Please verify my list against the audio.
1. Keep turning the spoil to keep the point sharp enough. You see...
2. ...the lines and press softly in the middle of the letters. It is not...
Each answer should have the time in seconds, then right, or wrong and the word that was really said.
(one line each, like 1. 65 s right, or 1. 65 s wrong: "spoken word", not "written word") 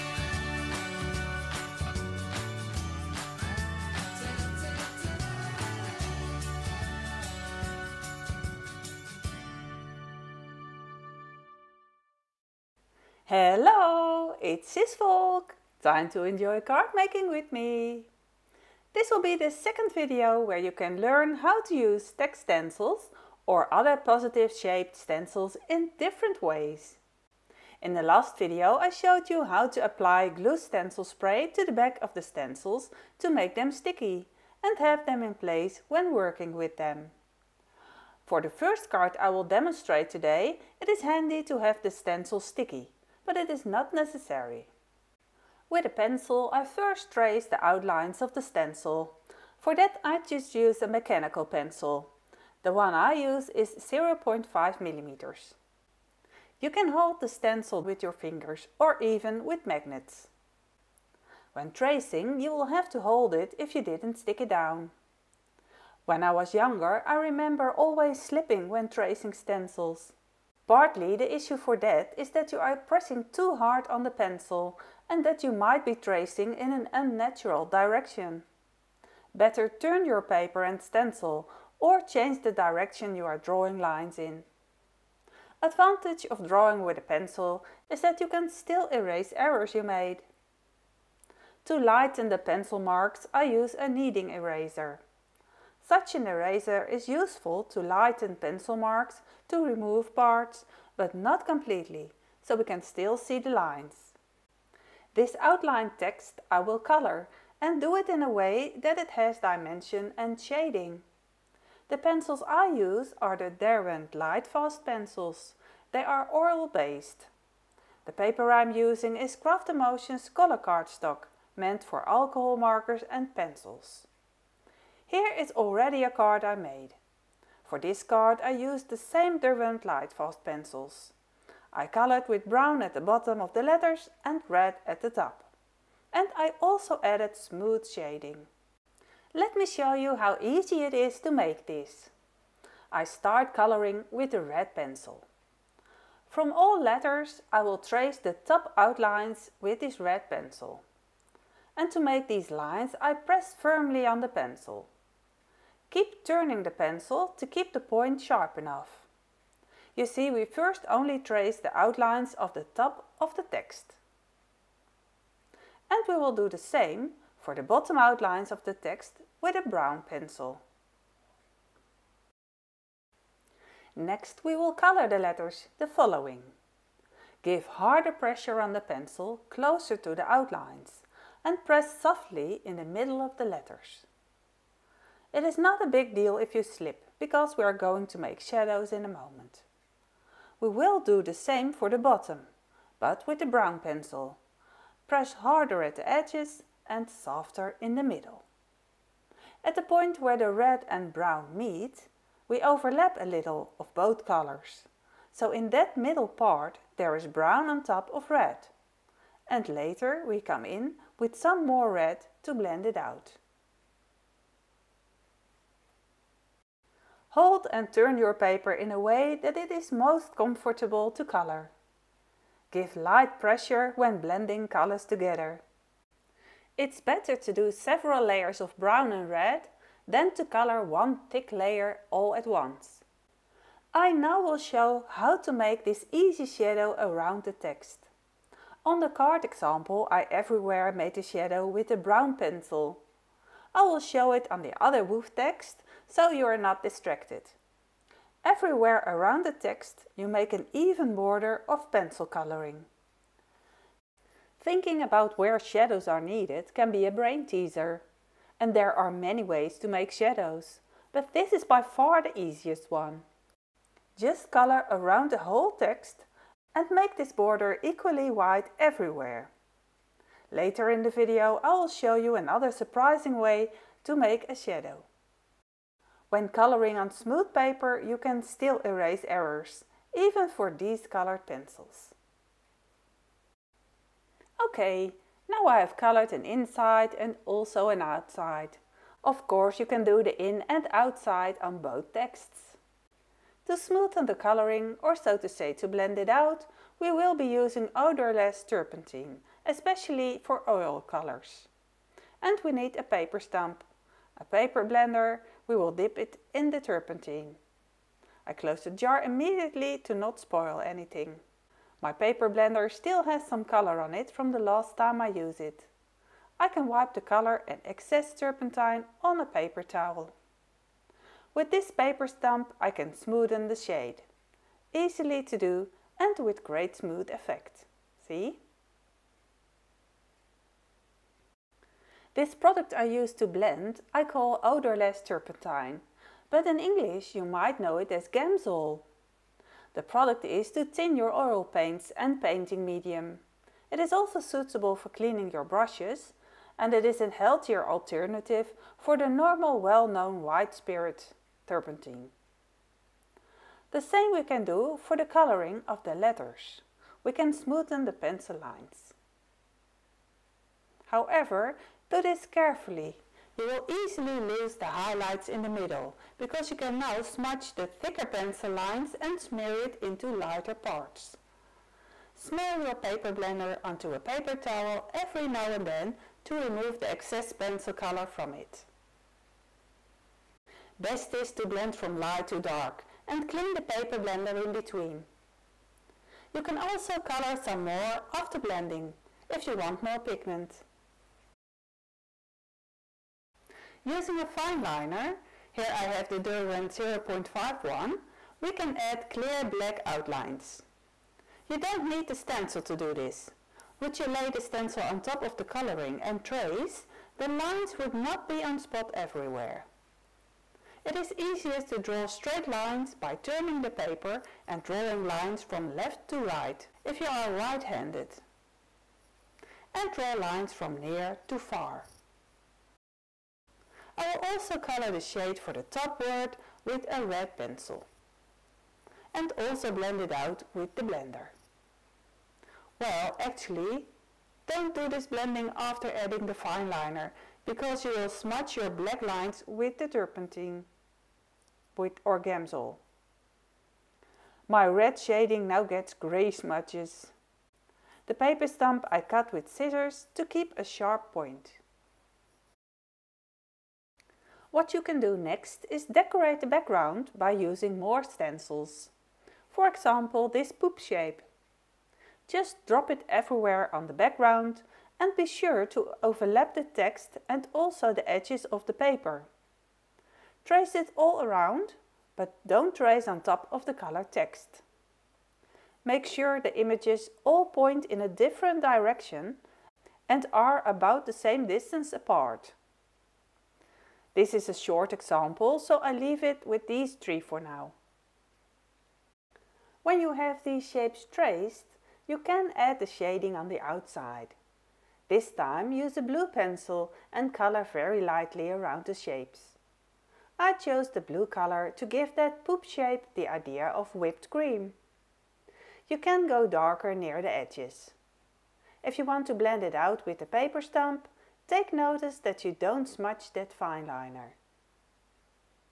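1. 155 s wrong: "pencil", not "spoil"
2. 180 s wrong: "outlines", not "lines".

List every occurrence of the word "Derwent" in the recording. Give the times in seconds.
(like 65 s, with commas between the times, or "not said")
113 s, 129 s, 396 s.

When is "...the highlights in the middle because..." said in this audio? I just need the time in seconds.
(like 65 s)
364 s.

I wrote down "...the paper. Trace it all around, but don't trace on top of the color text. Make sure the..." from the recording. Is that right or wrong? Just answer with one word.
right.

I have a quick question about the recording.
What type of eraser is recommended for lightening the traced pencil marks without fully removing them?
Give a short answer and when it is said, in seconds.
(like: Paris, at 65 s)
kneading eraser, at 93 s.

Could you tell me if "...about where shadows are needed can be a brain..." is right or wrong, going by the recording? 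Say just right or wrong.
right.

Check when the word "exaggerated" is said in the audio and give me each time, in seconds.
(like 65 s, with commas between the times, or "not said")
not said.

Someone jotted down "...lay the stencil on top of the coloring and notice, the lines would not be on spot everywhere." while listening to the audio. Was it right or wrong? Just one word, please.
wrong.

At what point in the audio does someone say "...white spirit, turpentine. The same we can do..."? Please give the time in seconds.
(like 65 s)
350 s.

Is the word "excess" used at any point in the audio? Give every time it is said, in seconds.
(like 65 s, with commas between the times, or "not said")
317 s, 377 s.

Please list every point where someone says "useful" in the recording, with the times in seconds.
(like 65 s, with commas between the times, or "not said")
97 s.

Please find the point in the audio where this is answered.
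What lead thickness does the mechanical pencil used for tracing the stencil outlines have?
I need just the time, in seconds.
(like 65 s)
53 s.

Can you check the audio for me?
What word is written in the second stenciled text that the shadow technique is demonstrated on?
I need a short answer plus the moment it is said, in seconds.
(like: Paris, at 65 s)
woof, at 245 s.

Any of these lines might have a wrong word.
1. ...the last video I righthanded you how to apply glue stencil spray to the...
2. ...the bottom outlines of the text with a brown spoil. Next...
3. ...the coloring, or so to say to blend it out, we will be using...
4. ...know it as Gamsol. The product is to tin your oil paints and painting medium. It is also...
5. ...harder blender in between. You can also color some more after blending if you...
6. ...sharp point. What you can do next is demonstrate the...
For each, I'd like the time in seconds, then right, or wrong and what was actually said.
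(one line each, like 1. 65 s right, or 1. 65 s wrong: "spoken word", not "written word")
1. 27 s wrong: "showed", not "righthanded"
2. 167 s wrong: "pencil", not "spoil"
3. 294 s right
4. 337 s right
5. 383 s wrong: "paper", not "harder"
6. 450 s wrong: "decorate", not "demonstrate".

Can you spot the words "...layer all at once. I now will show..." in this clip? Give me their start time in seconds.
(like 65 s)
231 s.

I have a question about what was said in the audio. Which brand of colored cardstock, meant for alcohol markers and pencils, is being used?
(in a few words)
Craft Emotions.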